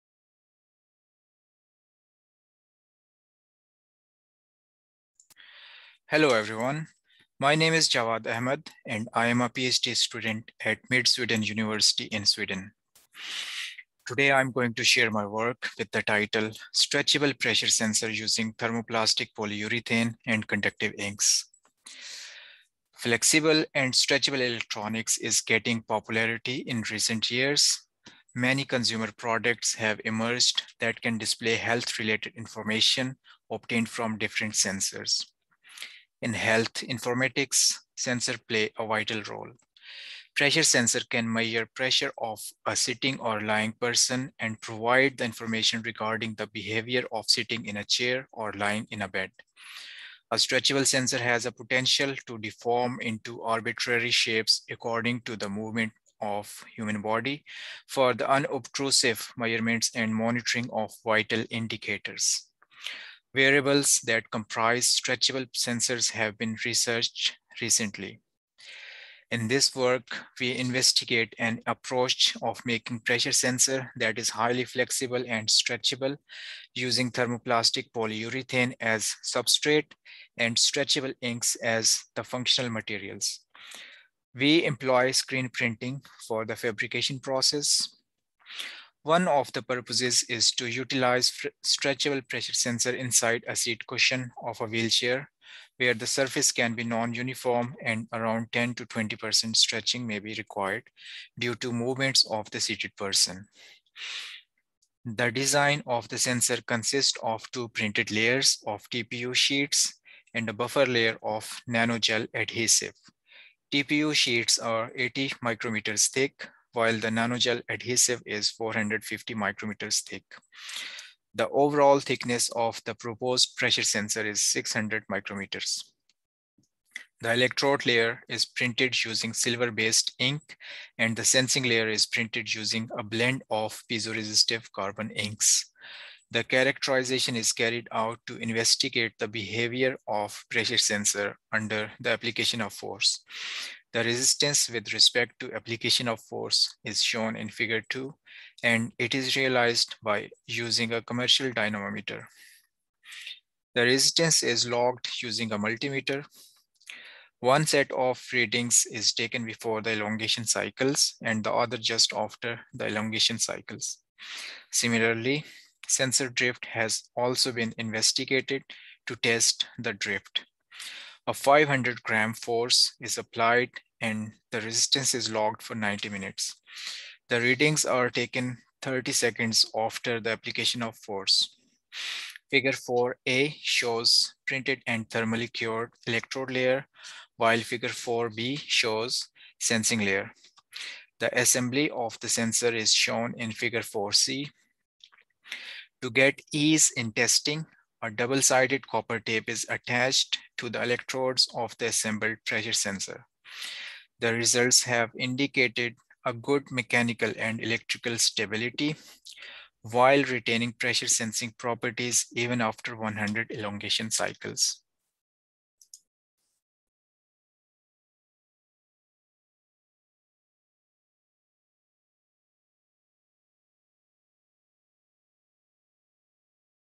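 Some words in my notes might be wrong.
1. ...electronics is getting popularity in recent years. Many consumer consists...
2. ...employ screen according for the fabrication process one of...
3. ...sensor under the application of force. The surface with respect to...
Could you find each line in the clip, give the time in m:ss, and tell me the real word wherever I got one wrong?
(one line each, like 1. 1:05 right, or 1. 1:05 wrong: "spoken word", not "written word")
1. 0:24 wrong: "products", not "consists"
2. 1:24 wrong: "printing", not "according"
3. 2:20 wrong: "resistance", not "surface".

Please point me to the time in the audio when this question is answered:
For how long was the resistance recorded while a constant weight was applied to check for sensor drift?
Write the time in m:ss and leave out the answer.
2:55.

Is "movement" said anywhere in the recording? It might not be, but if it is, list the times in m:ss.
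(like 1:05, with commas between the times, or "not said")
0:55, 1:41.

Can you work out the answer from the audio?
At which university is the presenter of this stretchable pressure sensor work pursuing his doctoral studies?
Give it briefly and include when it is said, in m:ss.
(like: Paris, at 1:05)
Mid Sweden University, at 0:10.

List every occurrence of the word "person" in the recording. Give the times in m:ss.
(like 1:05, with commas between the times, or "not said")
0:43, 1:42.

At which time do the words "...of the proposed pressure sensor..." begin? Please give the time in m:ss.
2:02.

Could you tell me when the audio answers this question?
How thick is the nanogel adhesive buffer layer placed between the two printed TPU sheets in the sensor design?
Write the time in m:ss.
1:58.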